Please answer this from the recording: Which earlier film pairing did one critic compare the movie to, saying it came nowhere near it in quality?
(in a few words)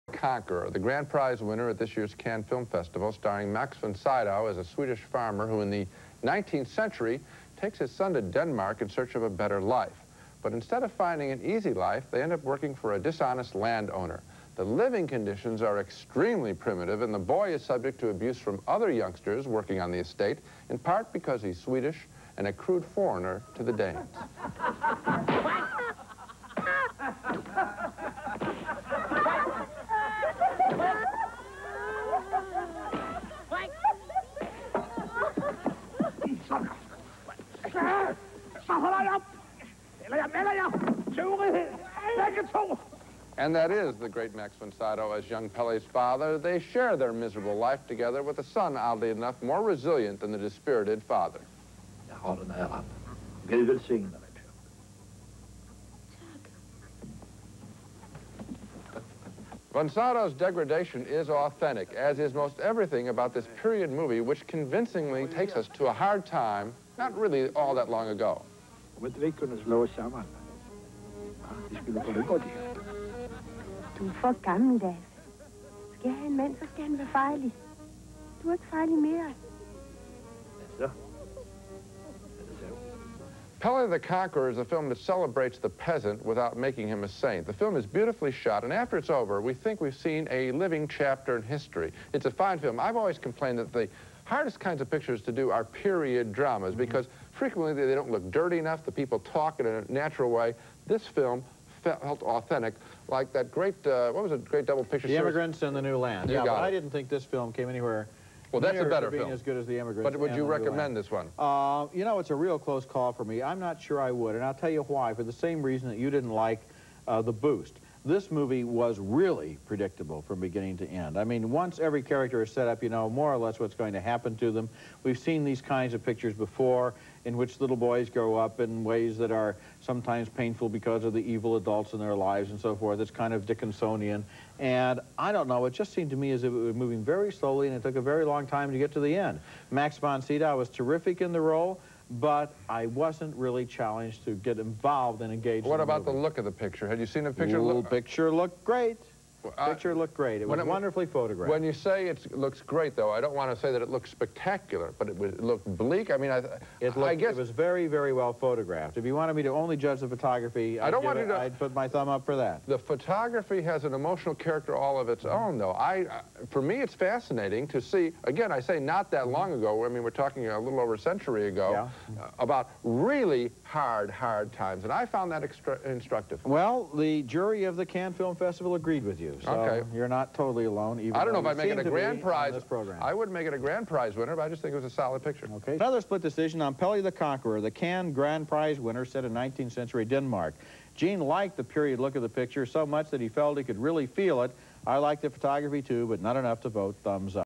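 The Emigrants.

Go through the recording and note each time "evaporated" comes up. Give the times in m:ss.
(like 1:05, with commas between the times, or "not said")
not said.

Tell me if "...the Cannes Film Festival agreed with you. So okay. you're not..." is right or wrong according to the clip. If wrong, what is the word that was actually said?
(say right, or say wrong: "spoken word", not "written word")
right.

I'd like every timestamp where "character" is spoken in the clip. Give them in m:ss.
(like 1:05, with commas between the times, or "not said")
2:02, 2:44.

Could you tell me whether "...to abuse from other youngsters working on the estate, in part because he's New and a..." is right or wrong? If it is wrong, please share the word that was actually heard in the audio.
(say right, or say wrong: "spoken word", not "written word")
wrong: "Swedish", not "New".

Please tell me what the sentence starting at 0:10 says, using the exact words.
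But instead of finding an easy life, they end up working for a dishonest landowner.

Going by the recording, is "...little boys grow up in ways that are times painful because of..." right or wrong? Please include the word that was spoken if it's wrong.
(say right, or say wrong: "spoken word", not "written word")
wrong: "sometimes", not "times".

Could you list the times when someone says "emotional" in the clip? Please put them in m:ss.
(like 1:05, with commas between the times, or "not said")
2:43.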